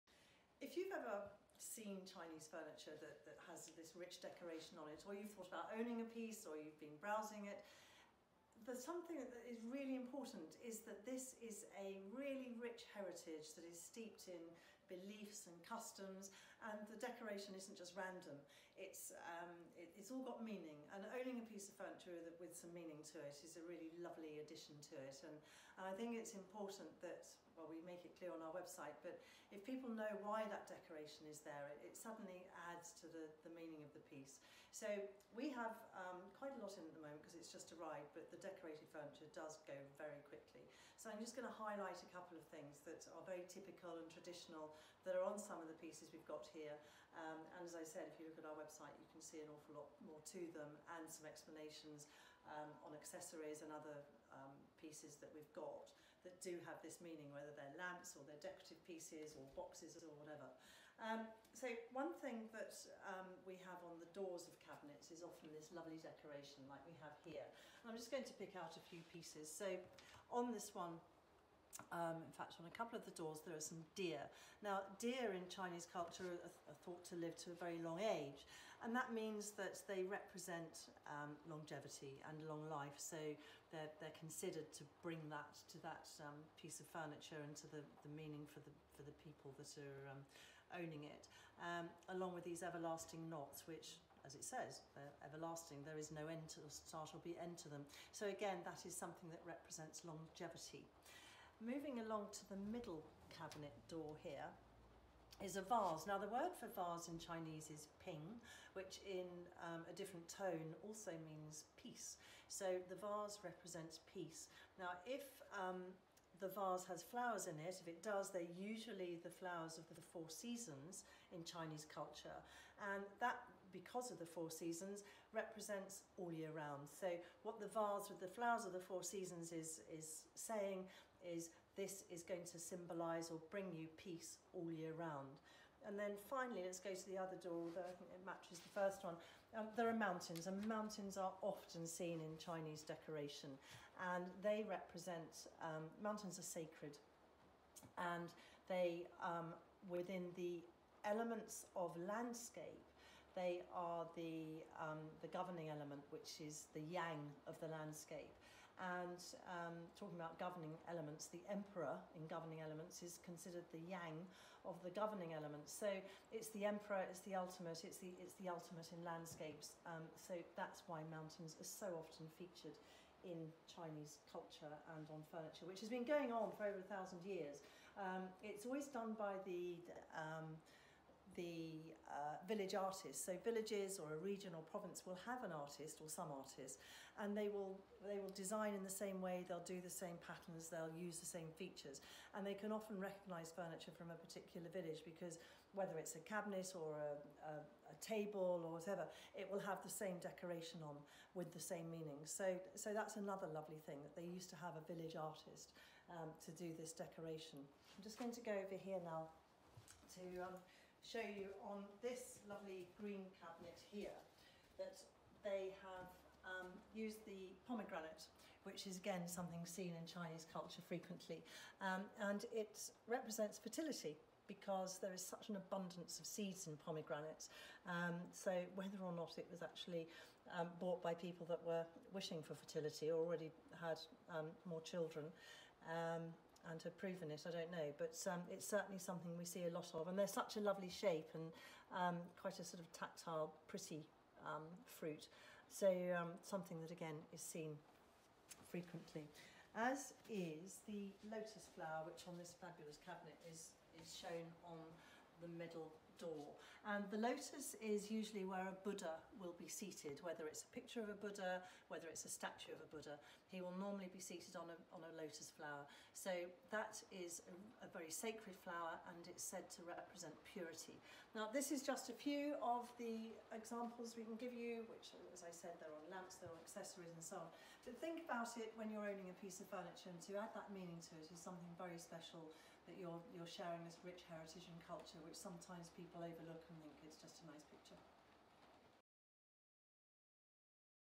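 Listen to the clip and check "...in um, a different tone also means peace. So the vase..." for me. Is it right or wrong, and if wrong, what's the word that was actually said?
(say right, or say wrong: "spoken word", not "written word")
right.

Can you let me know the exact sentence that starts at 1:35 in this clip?
There is no end to start or be end to them.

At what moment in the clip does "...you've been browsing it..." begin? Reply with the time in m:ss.
0:06.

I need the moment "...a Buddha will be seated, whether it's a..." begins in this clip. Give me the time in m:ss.
4:18.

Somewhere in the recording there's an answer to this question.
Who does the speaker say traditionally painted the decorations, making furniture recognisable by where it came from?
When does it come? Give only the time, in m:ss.
3:02.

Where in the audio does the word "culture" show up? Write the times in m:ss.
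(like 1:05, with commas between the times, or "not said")
1:15, 2:01, 2:54, 3:40, 4:44.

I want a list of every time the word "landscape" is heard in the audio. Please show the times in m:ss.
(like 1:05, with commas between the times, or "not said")
2:32, 2:37, 2:49.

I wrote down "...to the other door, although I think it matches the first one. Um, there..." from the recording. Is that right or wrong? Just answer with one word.
right.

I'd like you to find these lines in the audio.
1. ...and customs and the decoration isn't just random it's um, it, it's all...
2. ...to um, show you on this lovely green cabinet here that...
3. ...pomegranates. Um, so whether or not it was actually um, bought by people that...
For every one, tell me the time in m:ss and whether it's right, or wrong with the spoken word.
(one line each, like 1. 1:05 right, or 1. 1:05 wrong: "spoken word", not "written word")
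1. 0:15 right
2. 3:30 right
3. 3:46 right.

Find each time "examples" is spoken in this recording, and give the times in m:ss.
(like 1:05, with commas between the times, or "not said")
4:33.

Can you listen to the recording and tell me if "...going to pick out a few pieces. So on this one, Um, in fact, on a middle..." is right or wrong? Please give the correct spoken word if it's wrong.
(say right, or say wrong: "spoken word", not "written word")
wrong: "couple", not "middle".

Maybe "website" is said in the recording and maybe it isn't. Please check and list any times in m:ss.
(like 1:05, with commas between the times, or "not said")
0:28, 0:48.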